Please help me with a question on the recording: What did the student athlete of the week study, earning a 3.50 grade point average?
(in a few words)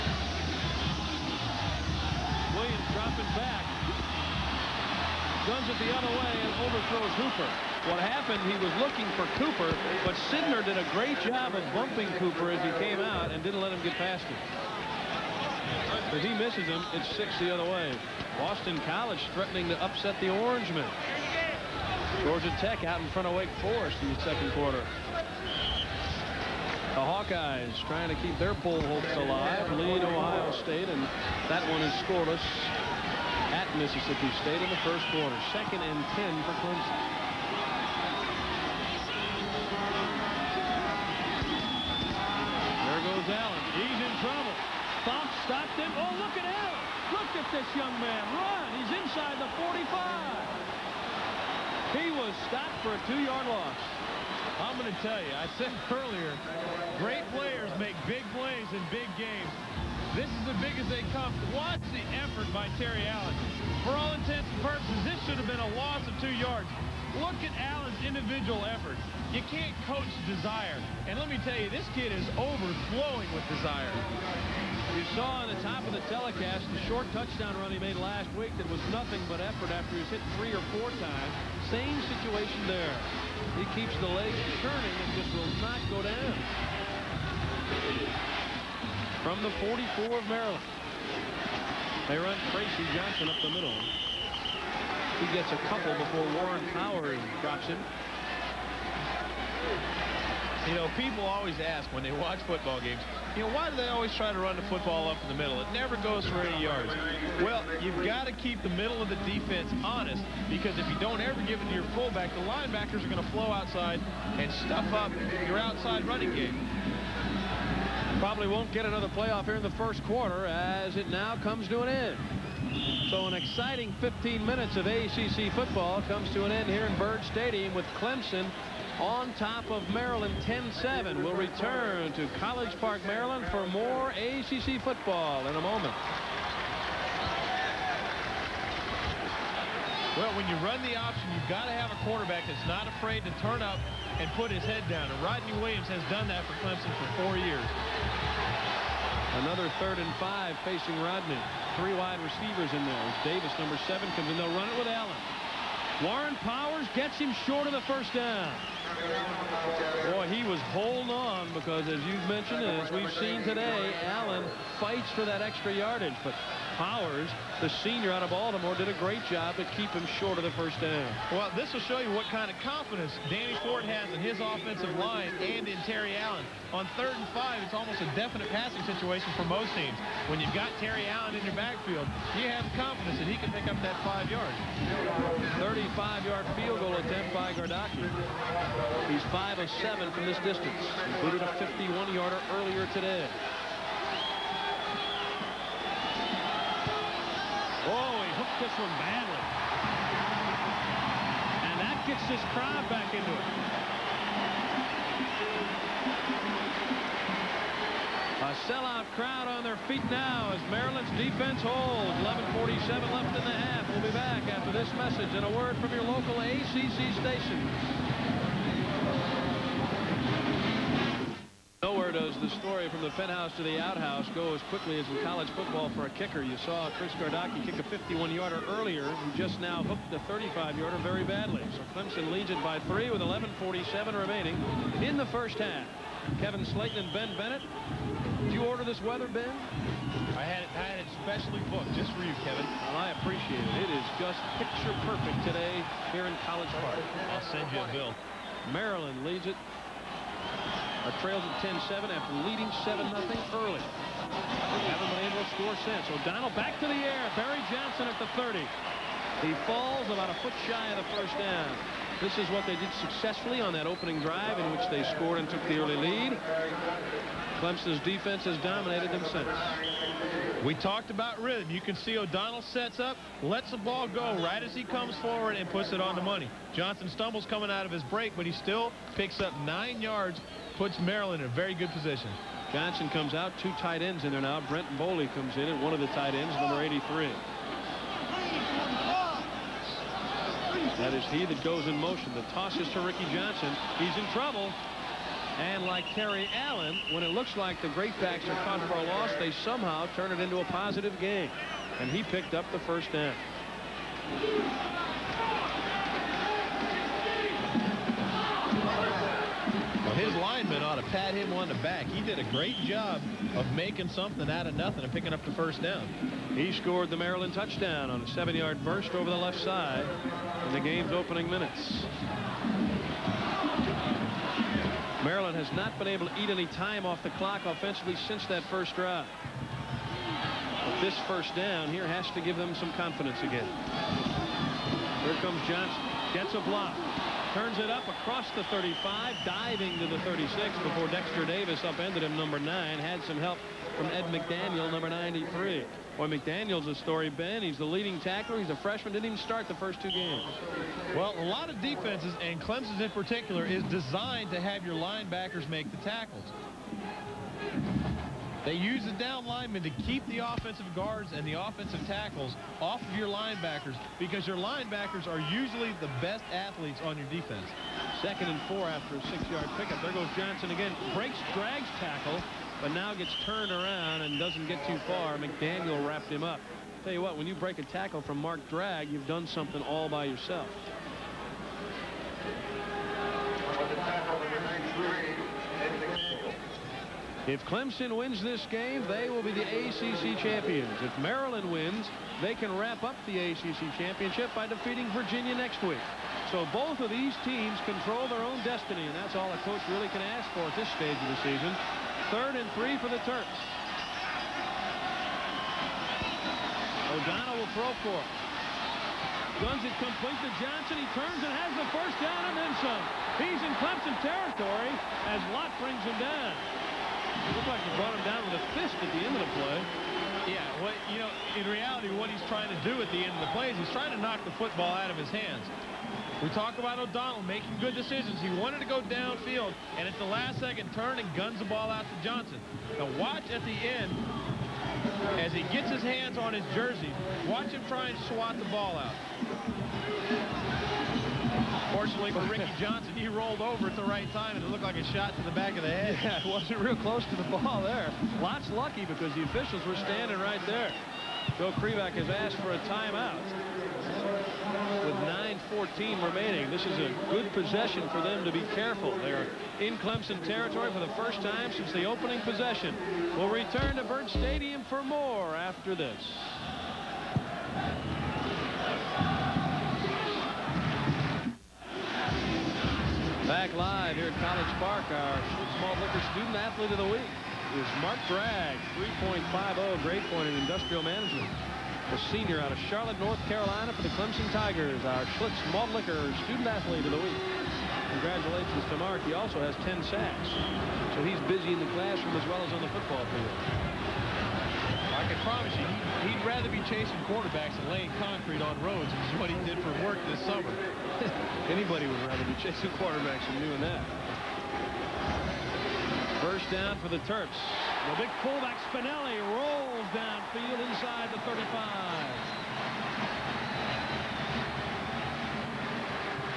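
Industrial management.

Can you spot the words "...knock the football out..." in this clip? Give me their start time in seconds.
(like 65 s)
424 s.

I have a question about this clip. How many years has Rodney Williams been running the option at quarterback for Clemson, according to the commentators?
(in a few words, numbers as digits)
4.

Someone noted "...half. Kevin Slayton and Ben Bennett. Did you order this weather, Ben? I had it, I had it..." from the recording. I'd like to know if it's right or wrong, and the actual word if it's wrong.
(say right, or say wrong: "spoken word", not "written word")
right.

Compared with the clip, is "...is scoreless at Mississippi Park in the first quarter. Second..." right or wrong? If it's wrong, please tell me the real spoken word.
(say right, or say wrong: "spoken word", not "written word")
wrong: "State", not "Park".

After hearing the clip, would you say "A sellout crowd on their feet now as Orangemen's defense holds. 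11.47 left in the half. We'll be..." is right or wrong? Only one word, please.
wrong.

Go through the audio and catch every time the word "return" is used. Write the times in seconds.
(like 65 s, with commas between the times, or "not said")
131 s, 463 s.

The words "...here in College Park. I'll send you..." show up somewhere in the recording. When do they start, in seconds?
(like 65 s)
246 s.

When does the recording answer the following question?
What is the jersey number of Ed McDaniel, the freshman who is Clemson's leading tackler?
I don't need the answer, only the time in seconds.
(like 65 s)
344 s.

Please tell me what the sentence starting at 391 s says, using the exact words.
If Maryland wins, they can wrap up the ACC championship by defeating Virginia next week.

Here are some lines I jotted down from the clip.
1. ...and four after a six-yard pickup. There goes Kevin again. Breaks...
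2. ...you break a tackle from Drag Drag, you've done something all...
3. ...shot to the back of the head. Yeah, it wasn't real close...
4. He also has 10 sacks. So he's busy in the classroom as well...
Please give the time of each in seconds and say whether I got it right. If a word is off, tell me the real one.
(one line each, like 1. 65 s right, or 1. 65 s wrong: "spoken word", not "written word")
1. 368 s wrong: "Johnson", not "Kevin"
2. 377 s wrong: "Mark", not "Drag"
3. 445 s right
4. 489 s right.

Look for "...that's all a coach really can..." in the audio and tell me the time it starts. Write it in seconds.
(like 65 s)
399 s.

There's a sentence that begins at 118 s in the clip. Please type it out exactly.
Probably won't get another playoff here in the first quarter as it now comes to an end.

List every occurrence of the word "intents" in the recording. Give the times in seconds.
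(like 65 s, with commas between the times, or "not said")
64 s.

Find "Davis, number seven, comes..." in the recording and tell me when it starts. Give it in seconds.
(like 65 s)
153 s.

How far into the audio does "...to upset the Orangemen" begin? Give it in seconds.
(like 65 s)
19 s.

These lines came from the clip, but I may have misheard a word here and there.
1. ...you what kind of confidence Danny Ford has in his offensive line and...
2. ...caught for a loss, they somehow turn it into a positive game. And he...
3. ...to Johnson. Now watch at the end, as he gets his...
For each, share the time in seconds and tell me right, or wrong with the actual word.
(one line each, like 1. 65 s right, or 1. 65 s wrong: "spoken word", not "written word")
1. 172 s right
2. 298 s right
3. 432 s right.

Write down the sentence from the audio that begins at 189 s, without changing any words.
He's 5 of 7 from this distance, included a 51-yarder earlier today.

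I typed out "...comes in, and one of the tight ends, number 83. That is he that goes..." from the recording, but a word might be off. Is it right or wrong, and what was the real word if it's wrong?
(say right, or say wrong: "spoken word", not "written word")
right.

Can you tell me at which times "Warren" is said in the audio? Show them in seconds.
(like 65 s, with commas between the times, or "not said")
96 s, 156 s.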